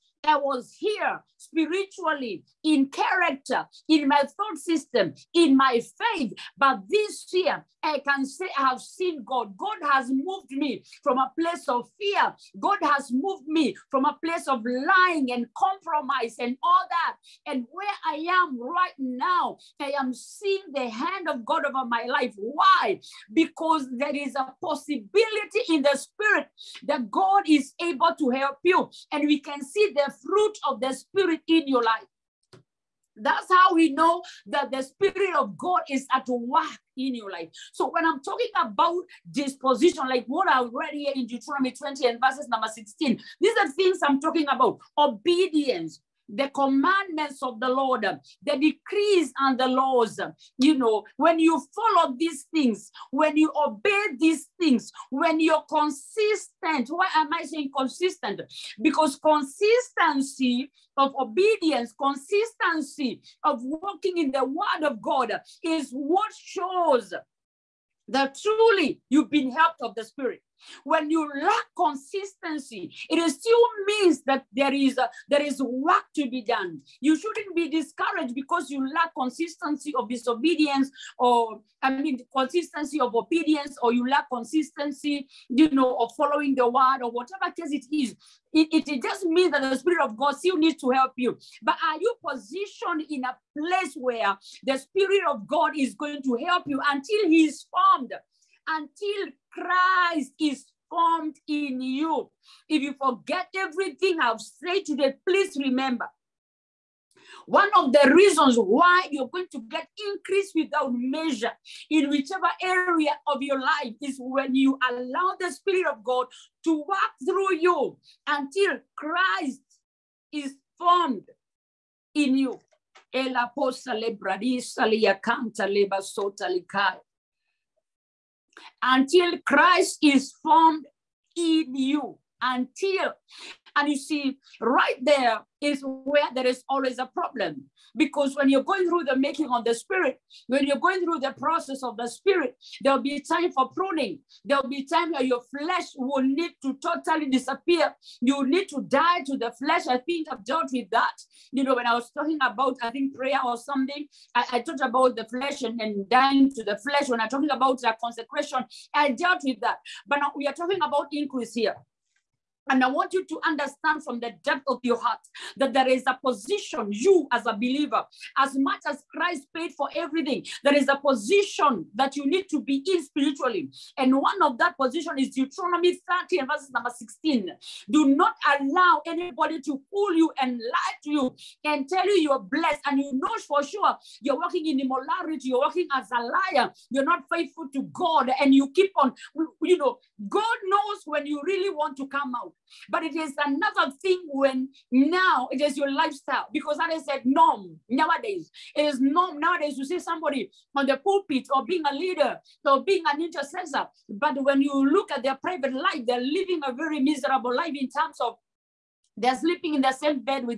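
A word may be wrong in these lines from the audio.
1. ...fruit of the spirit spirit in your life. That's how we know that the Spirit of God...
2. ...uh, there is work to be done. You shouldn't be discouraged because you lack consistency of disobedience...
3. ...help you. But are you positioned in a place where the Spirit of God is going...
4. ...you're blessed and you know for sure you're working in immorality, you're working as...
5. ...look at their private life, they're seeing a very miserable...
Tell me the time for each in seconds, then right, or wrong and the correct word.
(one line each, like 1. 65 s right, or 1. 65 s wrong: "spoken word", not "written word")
1. 30 s right
2. 75 s right
3. 90 s right
4. 182 s right
5. 204 s wrong: "living", not "seeing".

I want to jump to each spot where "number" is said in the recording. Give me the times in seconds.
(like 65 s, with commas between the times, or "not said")
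42 s, 176 s.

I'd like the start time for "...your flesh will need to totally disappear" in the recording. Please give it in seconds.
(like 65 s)
145 s.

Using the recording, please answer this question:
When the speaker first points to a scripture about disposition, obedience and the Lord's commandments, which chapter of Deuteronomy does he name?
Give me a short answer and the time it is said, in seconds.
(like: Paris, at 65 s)
20, at 41 s.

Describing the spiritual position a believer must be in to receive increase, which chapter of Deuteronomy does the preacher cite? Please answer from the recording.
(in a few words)
30.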